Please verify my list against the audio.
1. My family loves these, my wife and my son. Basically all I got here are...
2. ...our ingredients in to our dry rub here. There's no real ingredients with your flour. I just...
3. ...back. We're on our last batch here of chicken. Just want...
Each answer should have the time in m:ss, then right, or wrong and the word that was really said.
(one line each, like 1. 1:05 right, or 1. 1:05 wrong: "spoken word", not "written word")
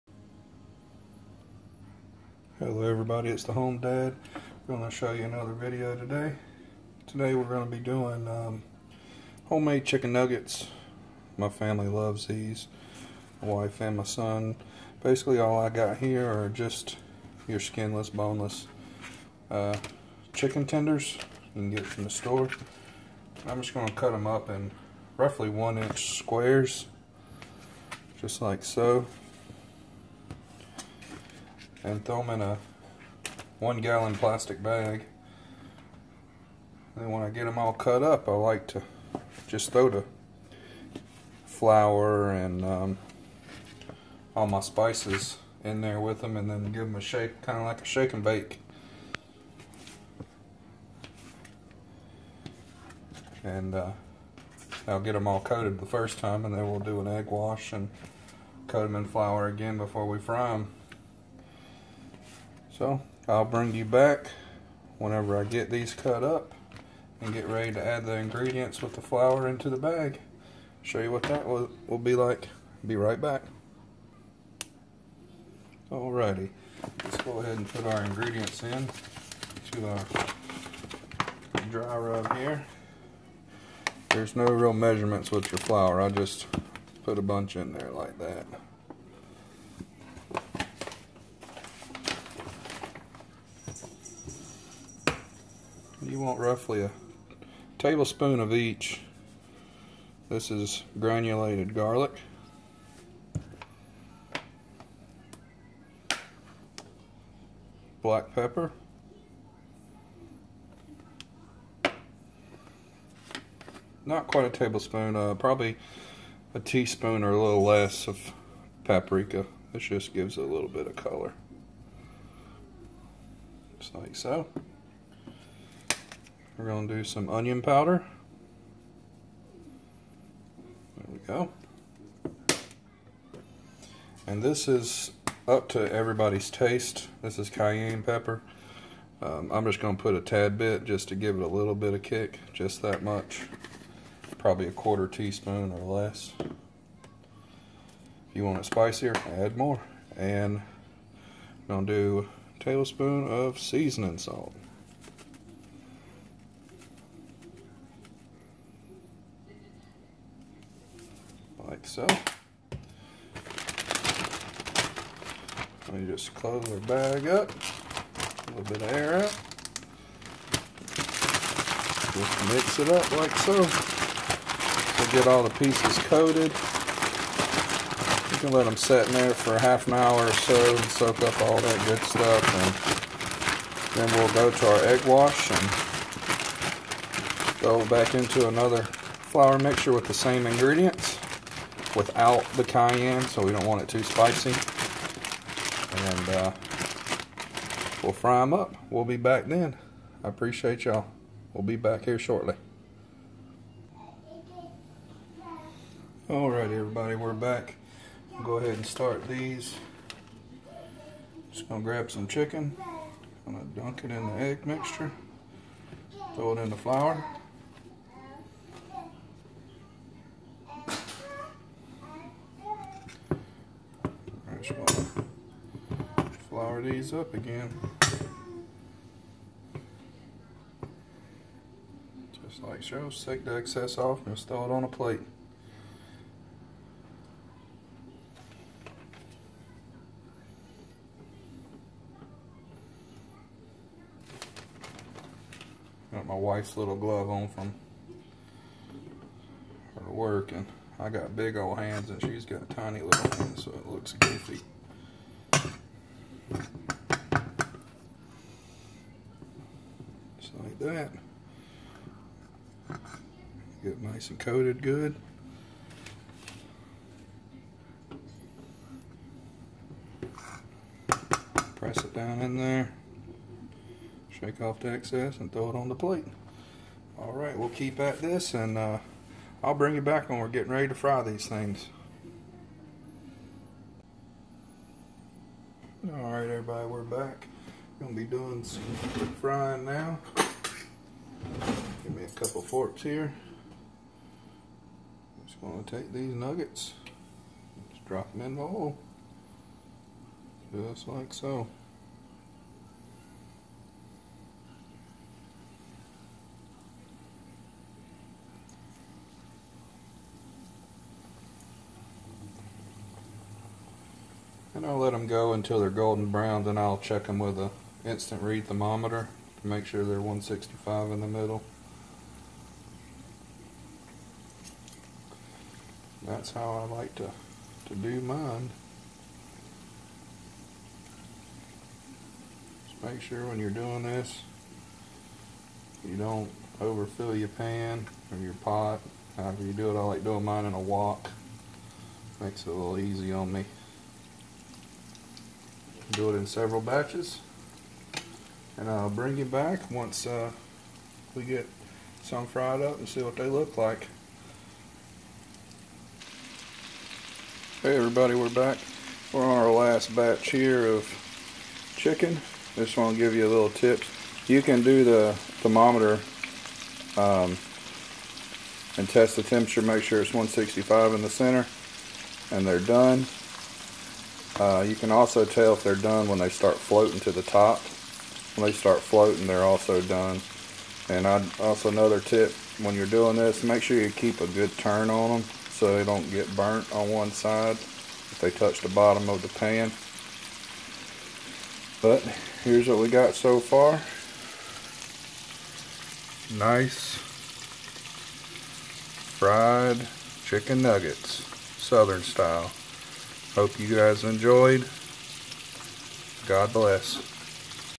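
1. 0:11 right
2. 1:17 wrong: "measurements", not "ingredients"
3. 5:58 right.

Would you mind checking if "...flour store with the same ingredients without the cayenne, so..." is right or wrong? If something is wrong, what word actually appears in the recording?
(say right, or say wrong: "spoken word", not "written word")
wrong: "mixture", not "store".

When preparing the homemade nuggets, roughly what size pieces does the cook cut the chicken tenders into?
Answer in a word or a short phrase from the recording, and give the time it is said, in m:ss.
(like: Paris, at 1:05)
1 inch squares, at 0:25.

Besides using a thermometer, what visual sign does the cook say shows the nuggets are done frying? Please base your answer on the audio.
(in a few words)
floating to the top.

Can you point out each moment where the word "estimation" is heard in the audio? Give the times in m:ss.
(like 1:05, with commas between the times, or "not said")
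not said.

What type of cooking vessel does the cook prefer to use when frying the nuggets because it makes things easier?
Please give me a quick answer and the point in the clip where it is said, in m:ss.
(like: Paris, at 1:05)
a wok, at 5:40.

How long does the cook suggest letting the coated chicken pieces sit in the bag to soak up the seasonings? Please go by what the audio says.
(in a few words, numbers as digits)
half an hour.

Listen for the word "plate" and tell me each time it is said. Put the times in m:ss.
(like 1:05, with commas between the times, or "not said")
3:54, 4:35.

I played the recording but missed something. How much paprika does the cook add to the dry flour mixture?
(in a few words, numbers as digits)
a teaspoon or a little less.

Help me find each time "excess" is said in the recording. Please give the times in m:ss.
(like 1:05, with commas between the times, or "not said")
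3:53, 4:34.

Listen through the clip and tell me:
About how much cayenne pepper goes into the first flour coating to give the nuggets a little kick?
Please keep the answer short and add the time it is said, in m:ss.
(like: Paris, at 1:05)
a quarter teaspoon or less, at 2:24.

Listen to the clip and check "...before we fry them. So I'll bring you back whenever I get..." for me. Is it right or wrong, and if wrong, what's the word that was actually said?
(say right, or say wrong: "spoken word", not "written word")
right.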